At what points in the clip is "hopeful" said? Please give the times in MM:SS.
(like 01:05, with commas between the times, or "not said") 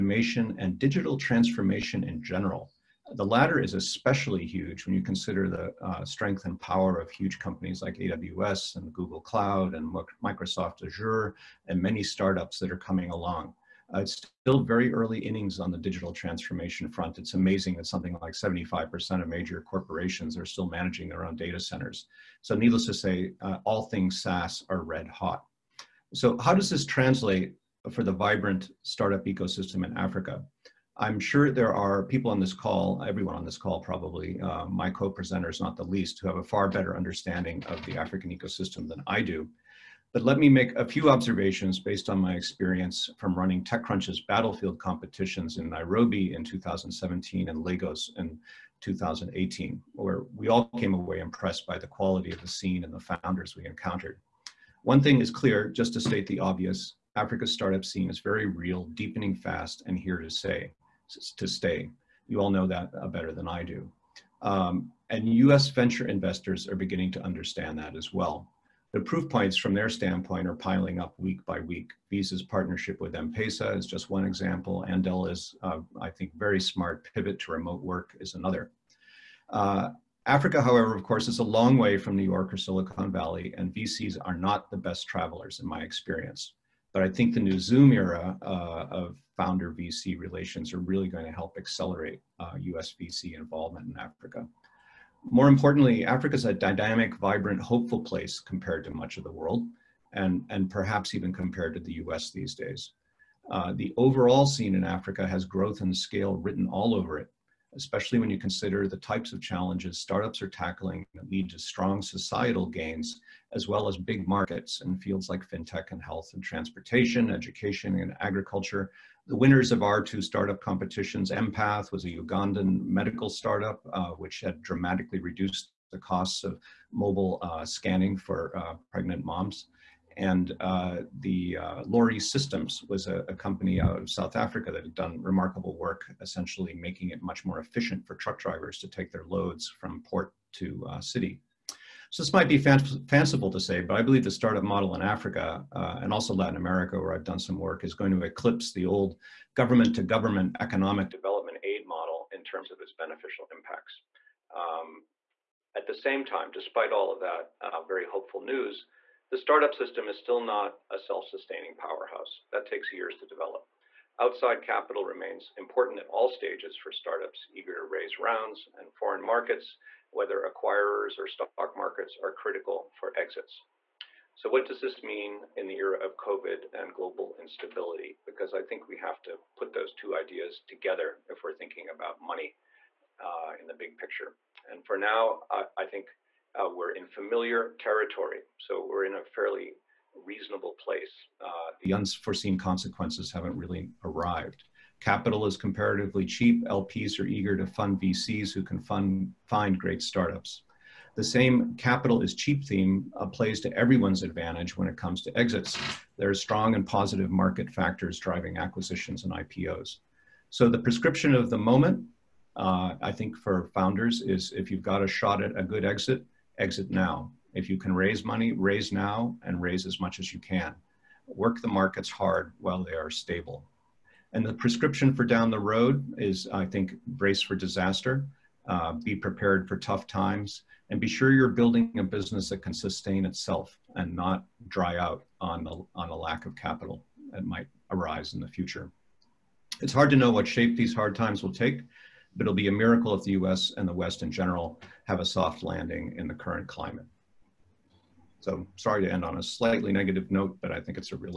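01:37, 02:38.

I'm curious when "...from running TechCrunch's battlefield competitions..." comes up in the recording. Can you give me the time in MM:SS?
00:43.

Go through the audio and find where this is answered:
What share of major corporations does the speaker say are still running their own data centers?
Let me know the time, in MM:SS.
00:18.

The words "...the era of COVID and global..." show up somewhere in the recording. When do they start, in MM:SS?
02:55.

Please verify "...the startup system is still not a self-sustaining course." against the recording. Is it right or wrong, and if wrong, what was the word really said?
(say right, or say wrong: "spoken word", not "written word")
wrong: "powerhouse", not "course".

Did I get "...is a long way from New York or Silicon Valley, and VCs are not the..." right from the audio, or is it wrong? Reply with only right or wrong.
right.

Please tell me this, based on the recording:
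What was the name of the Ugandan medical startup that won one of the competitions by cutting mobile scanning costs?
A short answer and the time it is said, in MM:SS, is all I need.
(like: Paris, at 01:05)
Empath, at 02:01.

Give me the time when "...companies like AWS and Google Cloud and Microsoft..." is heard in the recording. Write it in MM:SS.
00:07.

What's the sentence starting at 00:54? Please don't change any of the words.
One thing is clear, just to state the obvious, Africa's startup scene is very real, deepening fast, and here to stay.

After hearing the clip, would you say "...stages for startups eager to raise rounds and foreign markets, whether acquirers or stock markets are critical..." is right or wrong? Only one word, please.
right.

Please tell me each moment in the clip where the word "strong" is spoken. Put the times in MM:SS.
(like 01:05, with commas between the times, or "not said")
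01:51, 03:26.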